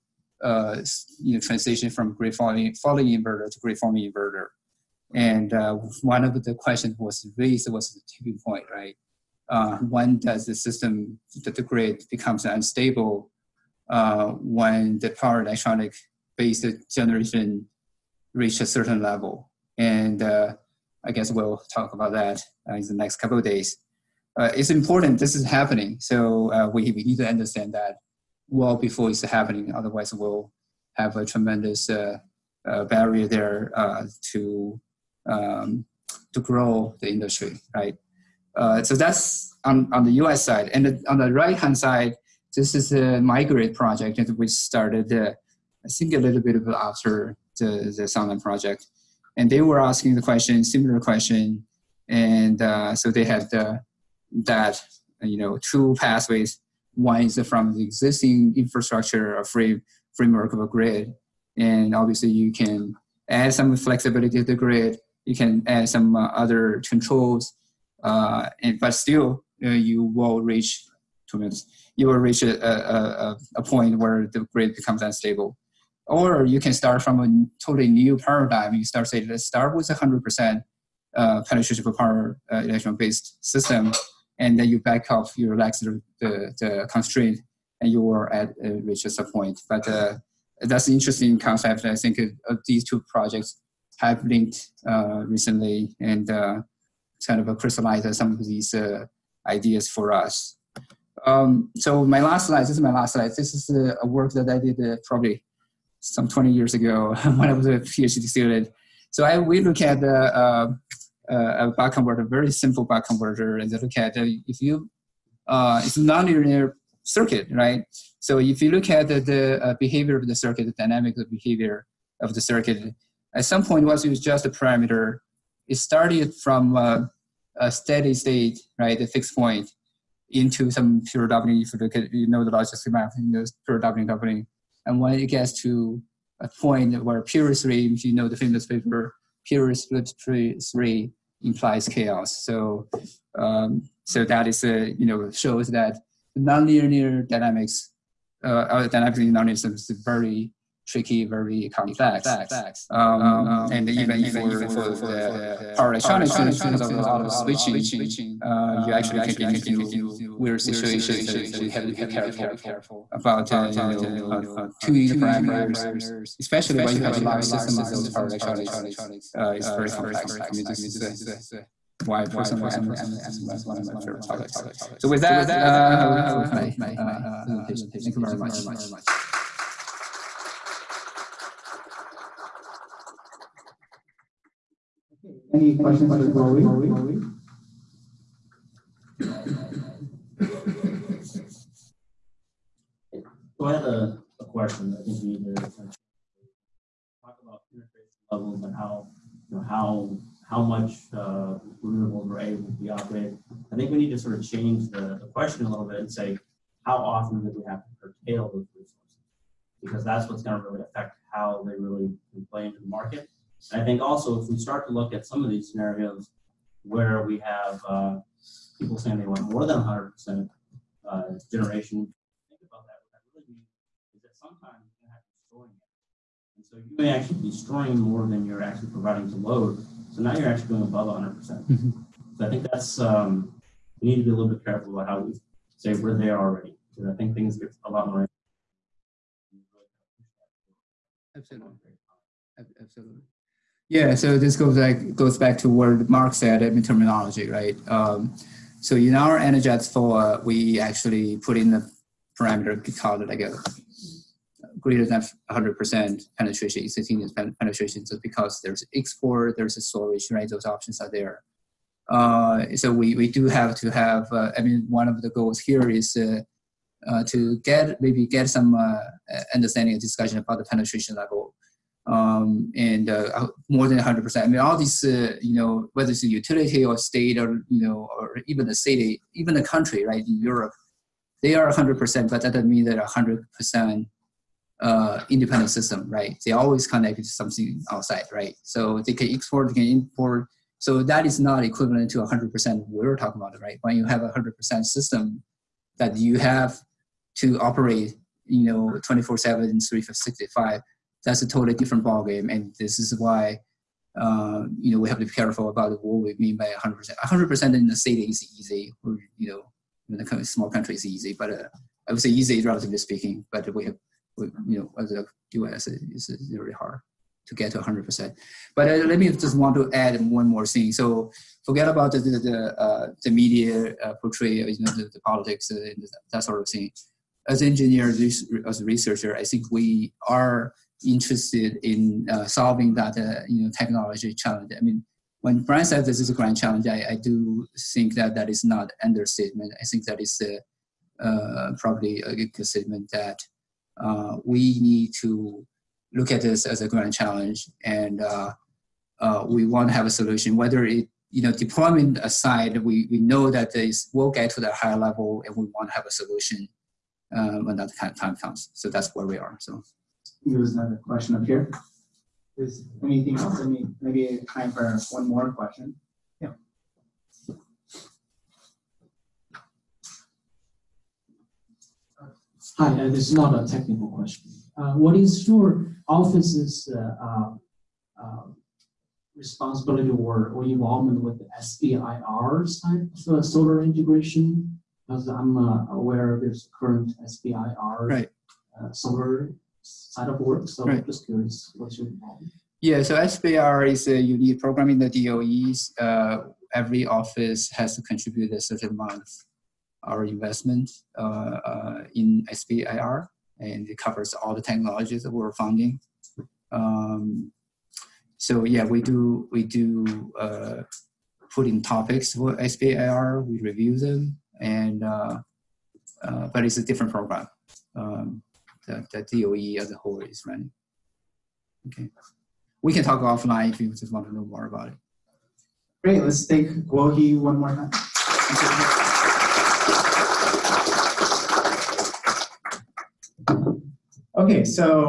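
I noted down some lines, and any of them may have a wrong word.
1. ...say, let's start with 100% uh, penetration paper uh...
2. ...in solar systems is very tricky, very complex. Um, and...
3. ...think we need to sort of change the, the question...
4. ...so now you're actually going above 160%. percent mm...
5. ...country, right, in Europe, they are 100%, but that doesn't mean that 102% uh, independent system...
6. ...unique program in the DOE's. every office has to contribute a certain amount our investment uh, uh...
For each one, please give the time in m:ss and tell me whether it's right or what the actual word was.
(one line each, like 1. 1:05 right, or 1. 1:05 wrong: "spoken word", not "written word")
1. 1:19 wrong: "power", not "paper"
2. 2:28 wrong: "nonlinear", not "solar"
3. 3:23 right
4. 3:50 wrong: "100", not "160"
5. 4:39 wrong: "100", not "102"
6. 6:34 right.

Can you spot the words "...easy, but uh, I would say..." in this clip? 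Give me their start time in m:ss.
5:11.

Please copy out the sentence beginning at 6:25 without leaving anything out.
Because I'm uh, aware there's current SBIR right.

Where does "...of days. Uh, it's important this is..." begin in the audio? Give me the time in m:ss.
0:23.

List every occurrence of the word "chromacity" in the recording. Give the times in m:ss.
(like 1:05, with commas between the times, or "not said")
not said.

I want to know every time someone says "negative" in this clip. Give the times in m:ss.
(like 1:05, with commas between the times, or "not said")
not said.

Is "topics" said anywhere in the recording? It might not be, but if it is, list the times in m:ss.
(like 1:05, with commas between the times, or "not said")
2:54, 6:51.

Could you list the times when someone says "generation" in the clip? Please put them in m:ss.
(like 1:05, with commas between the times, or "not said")
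0:16, 3:41.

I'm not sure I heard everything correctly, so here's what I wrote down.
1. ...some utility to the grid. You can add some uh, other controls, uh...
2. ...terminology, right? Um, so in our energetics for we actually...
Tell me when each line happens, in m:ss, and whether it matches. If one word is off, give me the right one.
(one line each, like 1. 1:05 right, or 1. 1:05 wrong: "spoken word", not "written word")
1. 1:03 wrong: "flexibility", not "utility"
2. 4:06 right.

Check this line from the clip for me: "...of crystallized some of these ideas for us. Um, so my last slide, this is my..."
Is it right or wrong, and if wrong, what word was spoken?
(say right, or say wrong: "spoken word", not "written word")
right.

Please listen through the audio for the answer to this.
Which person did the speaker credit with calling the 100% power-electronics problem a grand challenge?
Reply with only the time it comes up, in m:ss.
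5:35.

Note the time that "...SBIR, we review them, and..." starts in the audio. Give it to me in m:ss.
6:52.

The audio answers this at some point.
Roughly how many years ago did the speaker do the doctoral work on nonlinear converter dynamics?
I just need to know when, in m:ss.
1:46.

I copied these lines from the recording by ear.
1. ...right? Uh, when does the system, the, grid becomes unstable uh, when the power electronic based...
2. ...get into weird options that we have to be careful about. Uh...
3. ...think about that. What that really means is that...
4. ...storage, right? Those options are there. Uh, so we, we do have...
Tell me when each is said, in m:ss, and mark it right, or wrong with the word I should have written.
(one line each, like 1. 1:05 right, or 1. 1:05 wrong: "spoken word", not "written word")
1. 0:08 right
2. 2:39 wrong: "situations", not "options"
3. 3:42 right
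4. 4:19 right.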